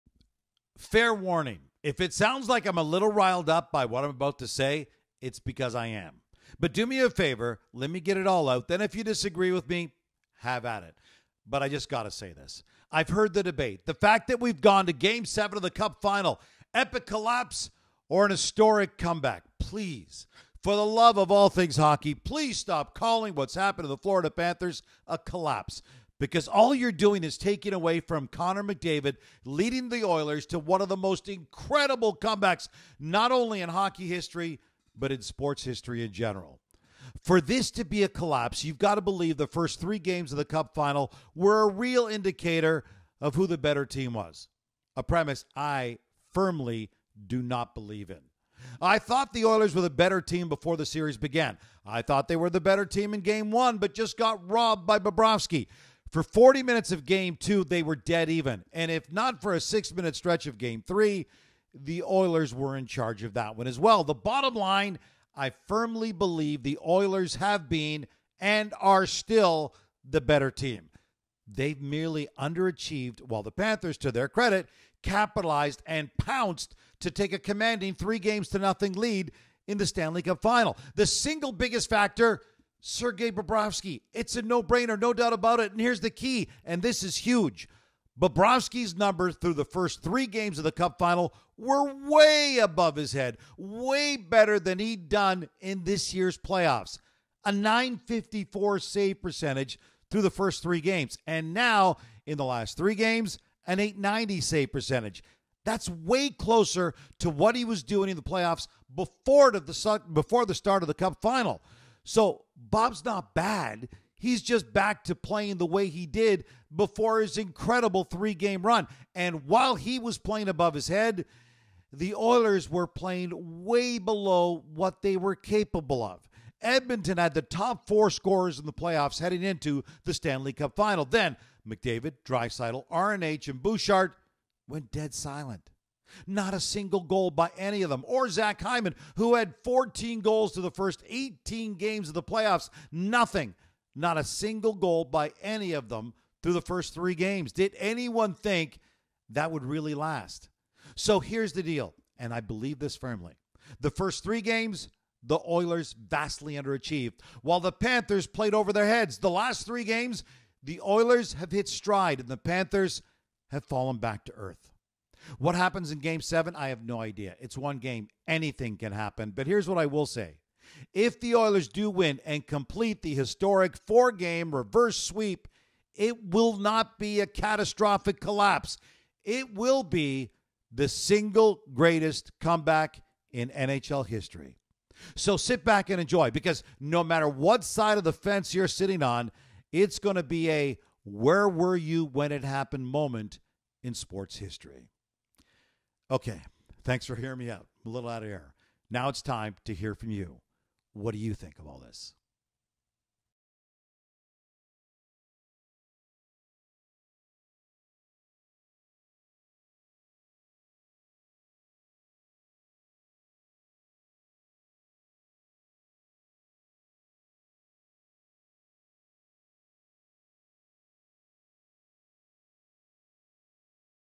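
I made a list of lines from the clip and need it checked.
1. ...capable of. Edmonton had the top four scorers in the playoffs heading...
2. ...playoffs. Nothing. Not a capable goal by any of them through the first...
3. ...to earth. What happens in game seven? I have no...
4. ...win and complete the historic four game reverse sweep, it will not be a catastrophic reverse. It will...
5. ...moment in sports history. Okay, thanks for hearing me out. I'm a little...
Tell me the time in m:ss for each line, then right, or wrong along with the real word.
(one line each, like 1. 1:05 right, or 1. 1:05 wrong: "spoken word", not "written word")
1. 2:05 right
2. 2:22 wrong: "single", not "capable"
3. 2:44 right
4. 2:51 wrong: "collapse", not "reverse"
5. 3:12 right.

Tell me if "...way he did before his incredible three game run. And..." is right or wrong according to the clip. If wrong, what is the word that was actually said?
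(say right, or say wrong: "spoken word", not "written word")
right.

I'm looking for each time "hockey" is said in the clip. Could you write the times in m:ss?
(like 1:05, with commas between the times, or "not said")
0:21, 0:33.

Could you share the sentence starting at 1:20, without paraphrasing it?
The single biggest factor Sergei Bobrovsky.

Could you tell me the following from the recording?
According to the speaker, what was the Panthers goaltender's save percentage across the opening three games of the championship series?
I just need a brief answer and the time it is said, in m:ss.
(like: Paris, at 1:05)
.954, at 1:37.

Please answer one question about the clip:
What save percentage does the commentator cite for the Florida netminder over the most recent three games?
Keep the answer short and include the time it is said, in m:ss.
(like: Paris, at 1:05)
.890, at 1:43.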